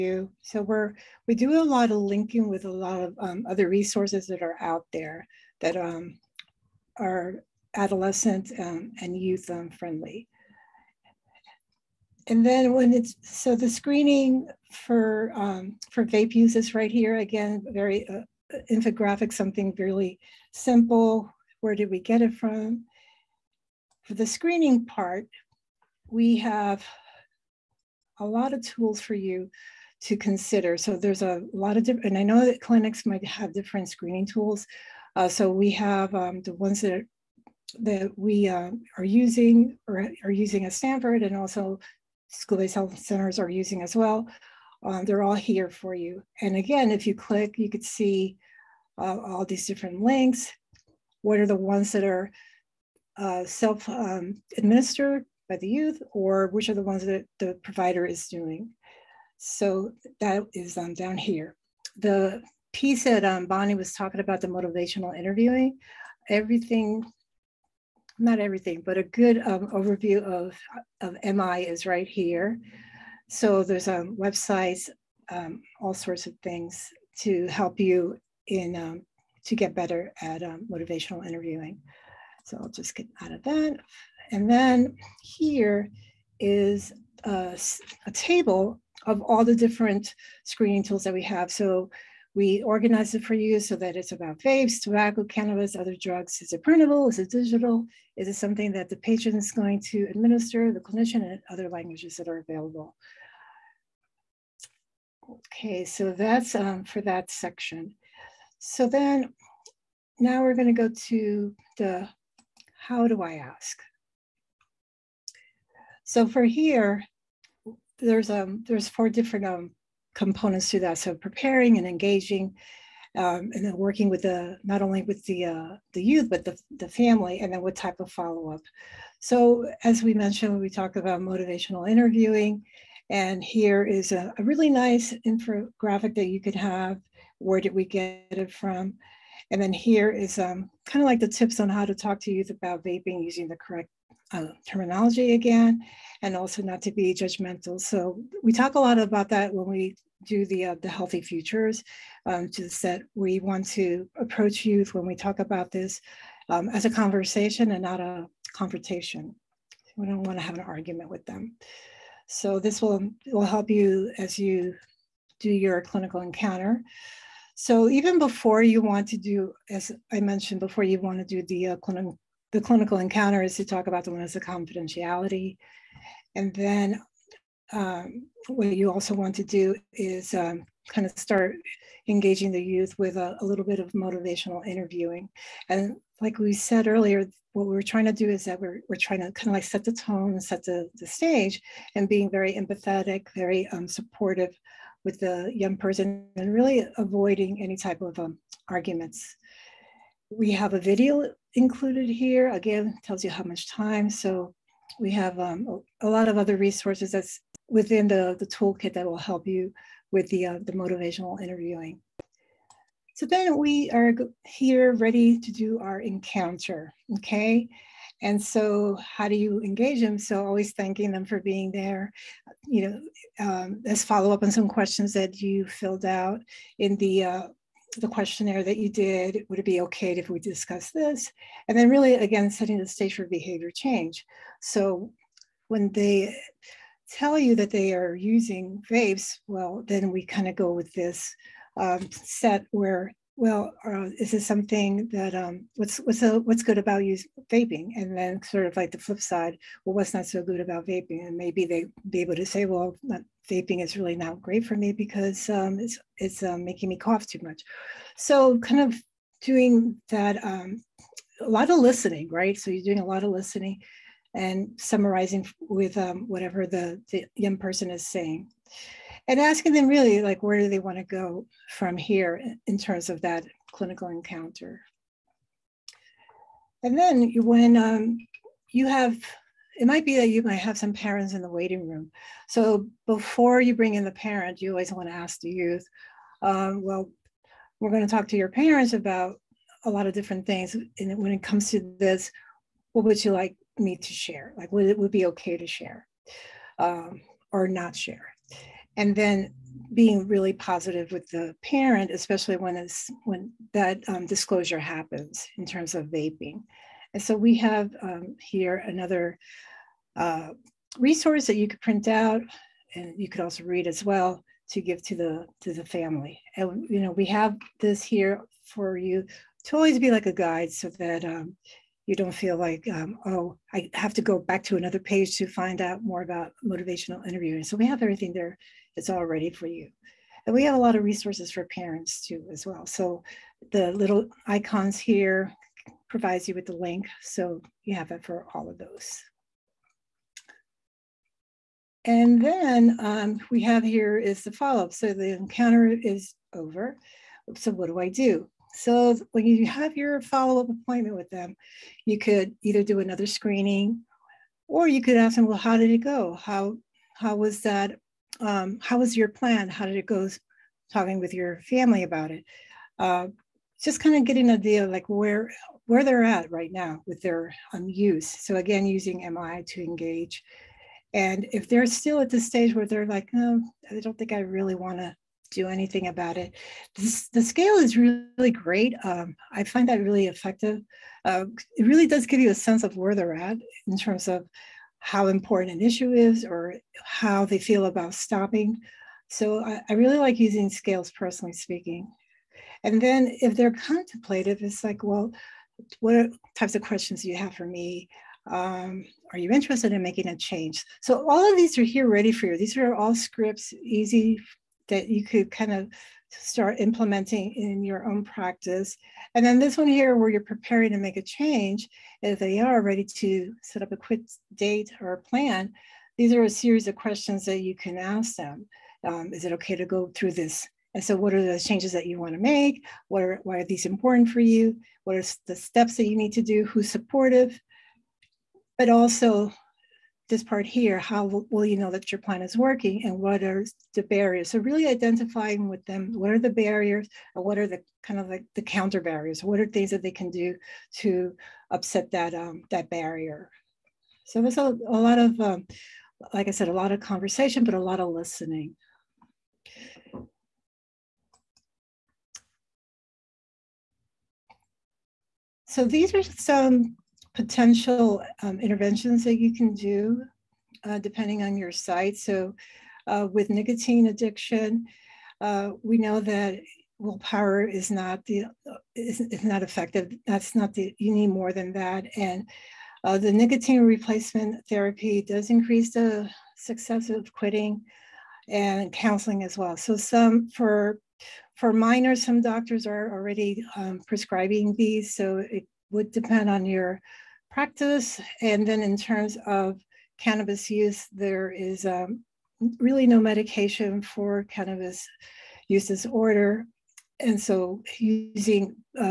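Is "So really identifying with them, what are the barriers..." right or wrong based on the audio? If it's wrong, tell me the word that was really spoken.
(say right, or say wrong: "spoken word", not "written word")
right.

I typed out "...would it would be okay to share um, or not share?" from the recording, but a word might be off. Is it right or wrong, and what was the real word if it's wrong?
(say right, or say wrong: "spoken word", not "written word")
right.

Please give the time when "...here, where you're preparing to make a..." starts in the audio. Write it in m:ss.
6:49.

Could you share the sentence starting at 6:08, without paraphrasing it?
So again, using MI to engage.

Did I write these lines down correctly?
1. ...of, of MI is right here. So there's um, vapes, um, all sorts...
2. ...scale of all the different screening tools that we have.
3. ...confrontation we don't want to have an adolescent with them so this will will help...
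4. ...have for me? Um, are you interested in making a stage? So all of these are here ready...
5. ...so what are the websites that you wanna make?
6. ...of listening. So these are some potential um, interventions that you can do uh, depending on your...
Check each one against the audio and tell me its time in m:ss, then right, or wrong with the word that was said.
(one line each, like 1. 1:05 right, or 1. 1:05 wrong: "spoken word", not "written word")
1. 1:10 wrong: "websites", not "vapes"
2. 1:28 wrong: "table", not "scale"
3. 2:38 wrong: "argument", not "adolescent"
4. 6:37 wrong: "change", not "stage"
5. 7:01 wrong: "changes", not "websites"
6. 7:28 right.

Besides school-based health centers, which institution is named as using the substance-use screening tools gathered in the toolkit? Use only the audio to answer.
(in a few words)
Stanford.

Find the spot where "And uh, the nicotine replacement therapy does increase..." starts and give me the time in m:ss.
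7:52.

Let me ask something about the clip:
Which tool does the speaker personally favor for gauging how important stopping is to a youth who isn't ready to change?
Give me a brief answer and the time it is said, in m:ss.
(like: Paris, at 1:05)
Scales, at 6:30.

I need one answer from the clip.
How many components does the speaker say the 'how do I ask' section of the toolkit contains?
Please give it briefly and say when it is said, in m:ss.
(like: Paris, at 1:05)
4, at 1:58.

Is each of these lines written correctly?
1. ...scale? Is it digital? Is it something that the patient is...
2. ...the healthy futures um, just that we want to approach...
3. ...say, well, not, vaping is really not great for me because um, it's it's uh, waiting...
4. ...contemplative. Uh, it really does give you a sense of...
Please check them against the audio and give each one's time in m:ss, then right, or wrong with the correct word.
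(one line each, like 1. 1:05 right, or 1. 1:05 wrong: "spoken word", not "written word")
1. 1:36 wrong: "printable", not "scale"
2. 2:30 right
3. 4:12 wrong: "making", not "waiting"
4. 6:20 wrong: "effective", not "contemplative".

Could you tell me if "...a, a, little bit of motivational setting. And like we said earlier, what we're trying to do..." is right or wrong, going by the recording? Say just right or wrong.
wrong.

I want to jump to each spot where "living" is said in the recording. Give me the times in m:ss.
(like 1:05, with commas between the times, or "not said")
not said.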